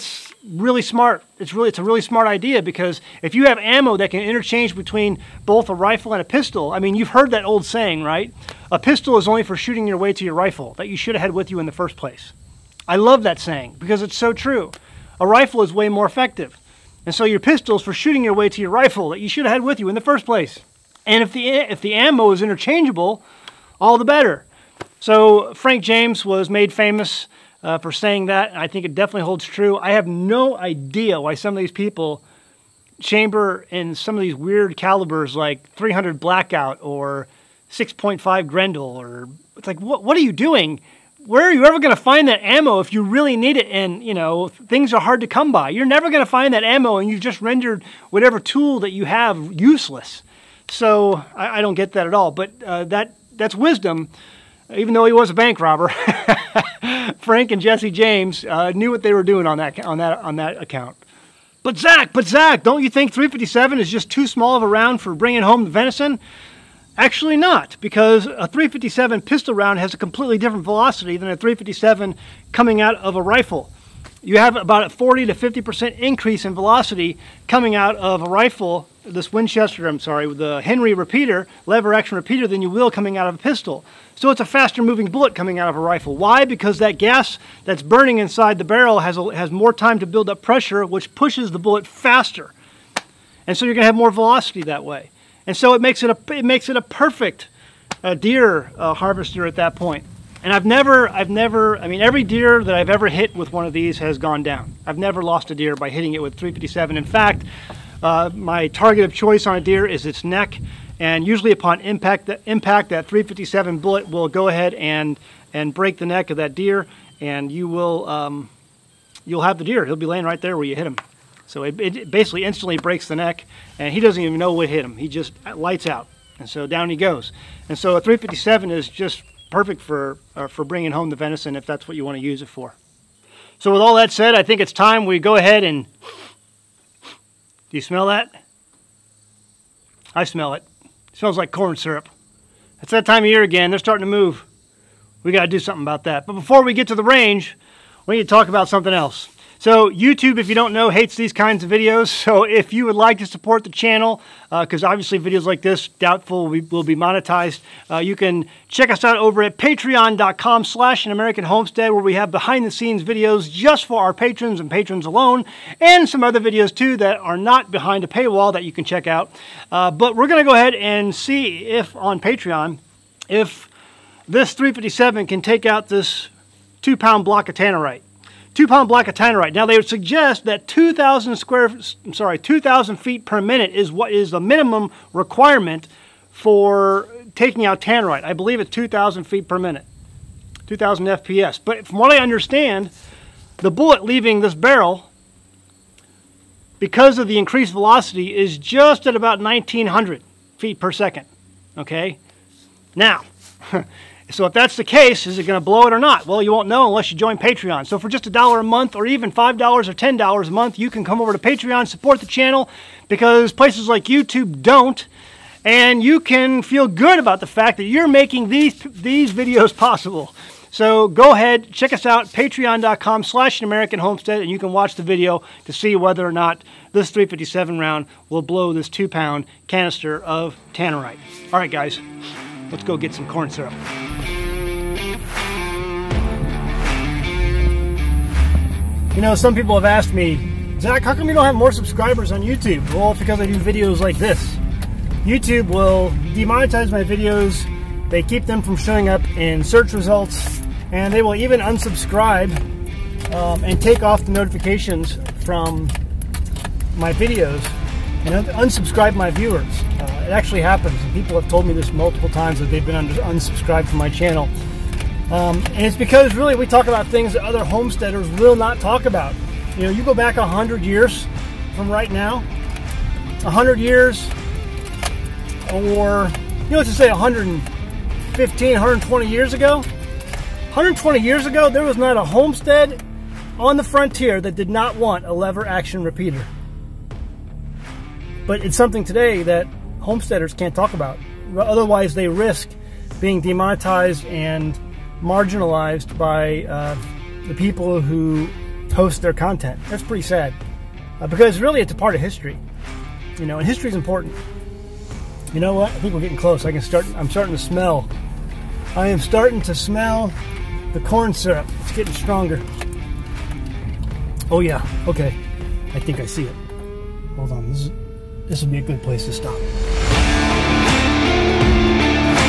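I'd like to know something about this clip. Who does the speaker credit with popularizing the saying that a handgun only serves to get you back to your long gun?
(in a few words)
Frank James.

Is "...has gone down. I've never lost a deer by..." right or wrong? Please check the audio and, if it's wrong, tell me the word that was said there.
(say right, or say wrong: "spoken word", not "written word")
right.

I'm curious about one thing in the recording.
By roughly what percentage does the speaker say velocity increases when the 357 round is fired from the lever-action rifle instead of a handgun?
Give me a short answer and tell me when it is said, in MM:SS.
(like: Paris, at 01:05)
40 to 50%, at 01:14.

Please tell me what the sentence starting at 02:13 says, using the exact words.
So with all that said, I think it's time we go ahead and, do you smell that?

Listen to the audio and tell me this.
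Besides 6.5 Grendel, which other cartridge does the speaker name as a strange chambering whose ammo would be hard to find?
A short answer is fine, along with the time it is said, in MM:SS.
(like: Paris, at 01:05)
300 Blackout, at 00:35.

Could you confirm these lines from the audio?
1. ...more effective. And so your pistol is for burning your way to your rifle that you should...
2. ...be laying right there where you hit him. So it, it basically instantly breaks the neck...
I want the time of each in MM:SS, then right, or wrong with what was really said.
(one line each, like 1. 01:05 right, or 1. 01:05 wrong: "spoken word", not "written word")
1. 00:15 wrong: "shooting", not "burning"
2. 01:59 right.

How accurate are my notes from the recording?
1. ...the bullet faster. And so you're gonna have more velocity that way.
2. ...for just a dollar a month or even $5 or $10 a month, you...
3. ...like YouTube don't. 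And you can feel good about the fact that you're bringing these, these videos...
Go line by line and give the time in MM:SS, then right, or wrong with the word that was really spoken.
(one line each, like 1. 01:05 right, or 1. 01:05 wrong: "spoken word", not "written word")
1. 01:31 right
2. 03:27 right
3. 03:33 wrong: "making", not "bringing".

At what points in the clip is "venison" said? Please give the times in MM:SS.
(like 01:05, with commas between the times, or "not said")
01:05, 02:11.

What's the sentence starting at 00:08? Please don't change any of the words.
A pistol is only for shooting your way to your rifle that you should have had with you in the first place.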